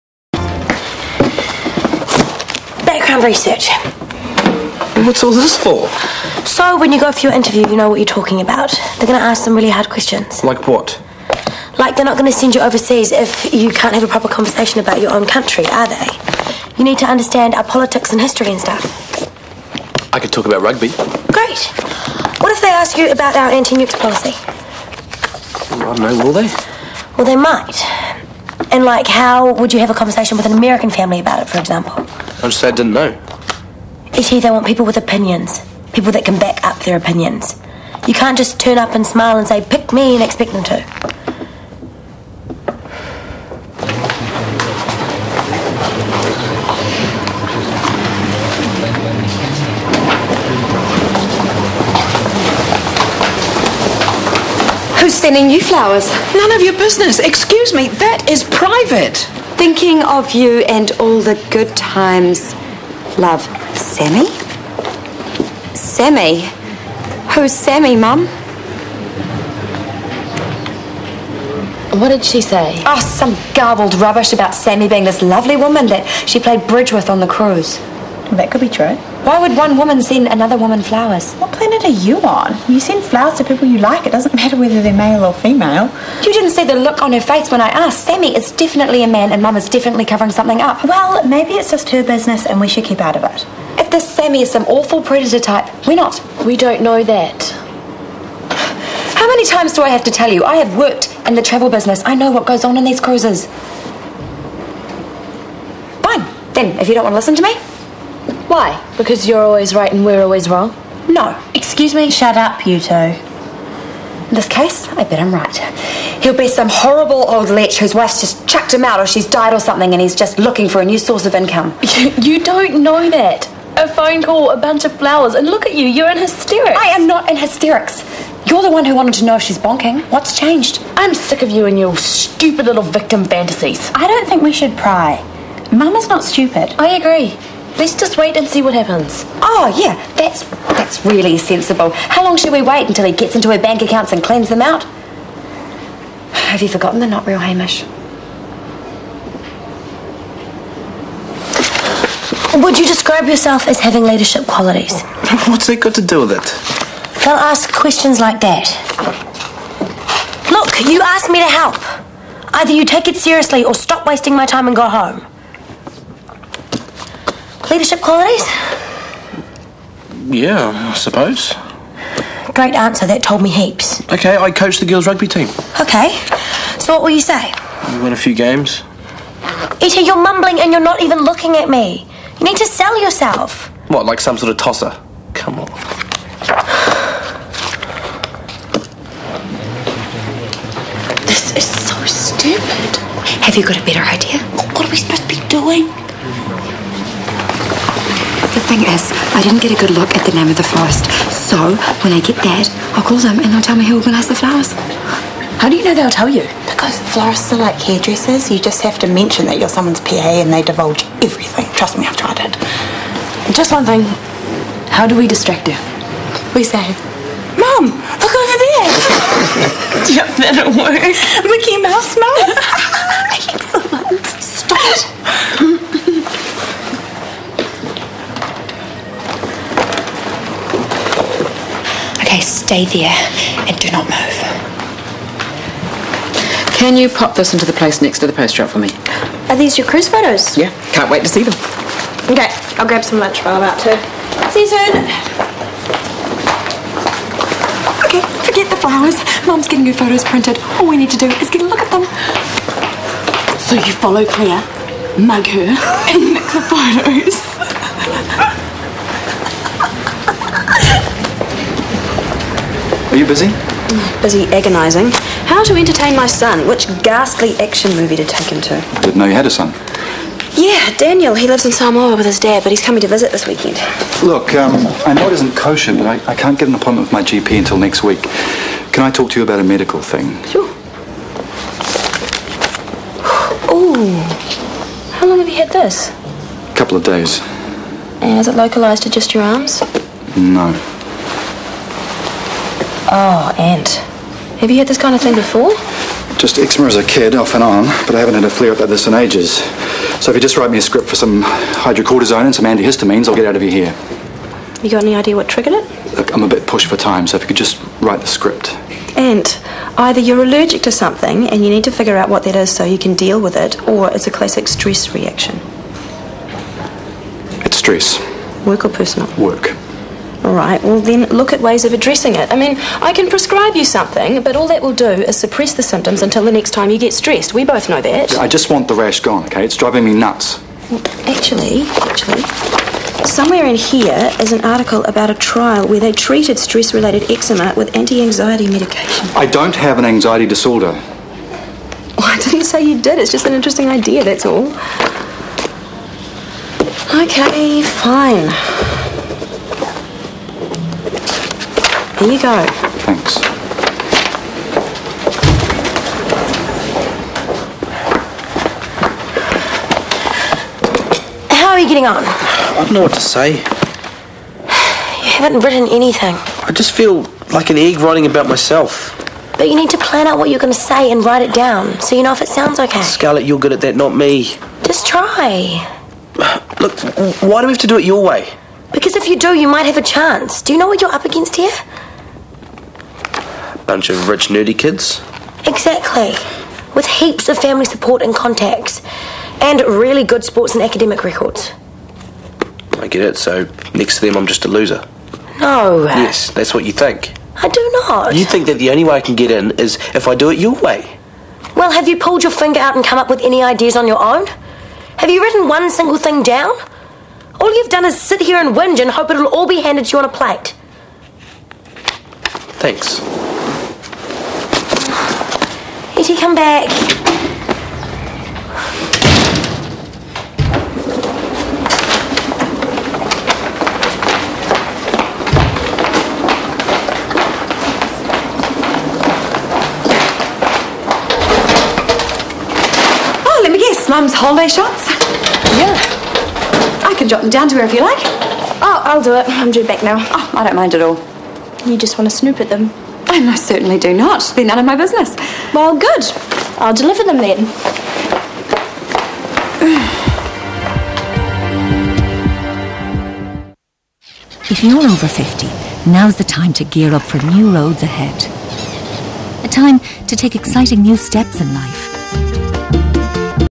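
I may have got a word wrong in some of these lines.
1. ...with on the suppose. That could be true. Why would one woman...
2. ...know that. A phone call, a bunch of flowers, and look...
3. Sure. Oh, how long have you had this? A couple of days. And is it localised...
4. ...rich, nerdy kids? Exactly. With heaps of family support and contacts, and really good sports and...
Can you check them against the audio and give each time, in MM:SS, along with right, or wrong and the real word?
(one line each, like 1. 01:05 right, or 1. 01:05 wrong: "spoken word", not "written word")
1. 01:16 wrong: "cruise", not "suppose"
2. 02:02 right
3. 04:40 right
4. 06:24 right.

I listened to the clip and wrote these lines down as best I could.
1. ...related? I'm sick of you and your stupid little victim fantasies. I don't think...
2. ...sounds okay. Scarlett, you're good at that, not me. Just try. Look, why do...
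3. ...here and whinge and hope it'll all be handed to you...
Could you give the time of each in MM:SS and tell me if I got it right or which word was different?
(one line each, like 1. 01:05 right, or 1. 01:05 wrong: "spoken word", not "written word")
1. 02:10 wrong: "changed", not "related"
2. 06:12 right
3. 06:48 right.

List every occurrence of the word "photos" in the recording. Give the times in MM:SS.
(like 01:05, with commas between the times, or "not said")
04:00, 04:09, 04:16.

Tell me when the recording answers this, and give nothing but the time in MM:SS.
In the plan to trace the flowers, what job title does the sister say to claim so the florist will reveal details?
03:30.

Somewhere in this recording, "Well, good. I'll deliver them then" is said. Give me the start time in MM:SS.
07:25.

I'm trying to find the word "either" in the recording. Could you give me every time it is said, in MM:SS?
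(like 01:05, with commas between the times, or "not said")
02:42, 05:09.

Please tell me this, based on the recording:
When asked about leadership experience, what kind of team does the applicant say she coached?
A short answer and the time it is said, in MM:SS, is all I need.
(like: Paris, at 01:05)
girls' rugby team, at 02:54.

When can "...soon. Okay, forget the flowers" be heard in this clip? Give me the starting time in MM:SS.
04:04.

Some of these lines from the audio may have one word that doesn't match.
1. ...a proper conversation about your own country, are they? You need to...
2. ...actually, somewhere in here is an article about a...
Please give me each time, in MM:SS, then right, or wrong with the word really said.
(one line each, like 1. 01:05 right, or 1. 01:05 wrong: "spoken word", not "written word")
1. 00:14 right
2. 05:32 right.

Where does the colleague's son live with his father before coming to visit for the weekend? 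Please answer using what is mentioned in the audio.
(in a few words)
Samoa.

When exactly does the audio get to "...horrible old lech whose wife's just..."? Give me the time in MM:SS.
01:56.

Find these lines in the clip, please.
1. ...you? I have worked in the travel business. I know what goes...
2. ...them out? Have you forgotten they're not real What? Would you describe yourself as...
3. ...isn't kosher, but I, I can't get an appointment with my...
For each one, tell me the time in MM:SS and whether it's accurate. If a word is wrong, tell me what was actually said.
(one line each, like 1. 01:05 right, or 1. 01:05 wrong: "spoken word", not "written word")
1. 01:40 right
2. 02:24 wrong: "Hamish", not "What"
3. 04:35 right.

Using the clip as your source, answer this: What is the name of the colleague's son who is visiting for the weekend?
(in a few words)
Daniel.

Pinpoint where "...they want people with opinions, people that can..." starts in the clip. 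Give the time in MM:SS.
00:34.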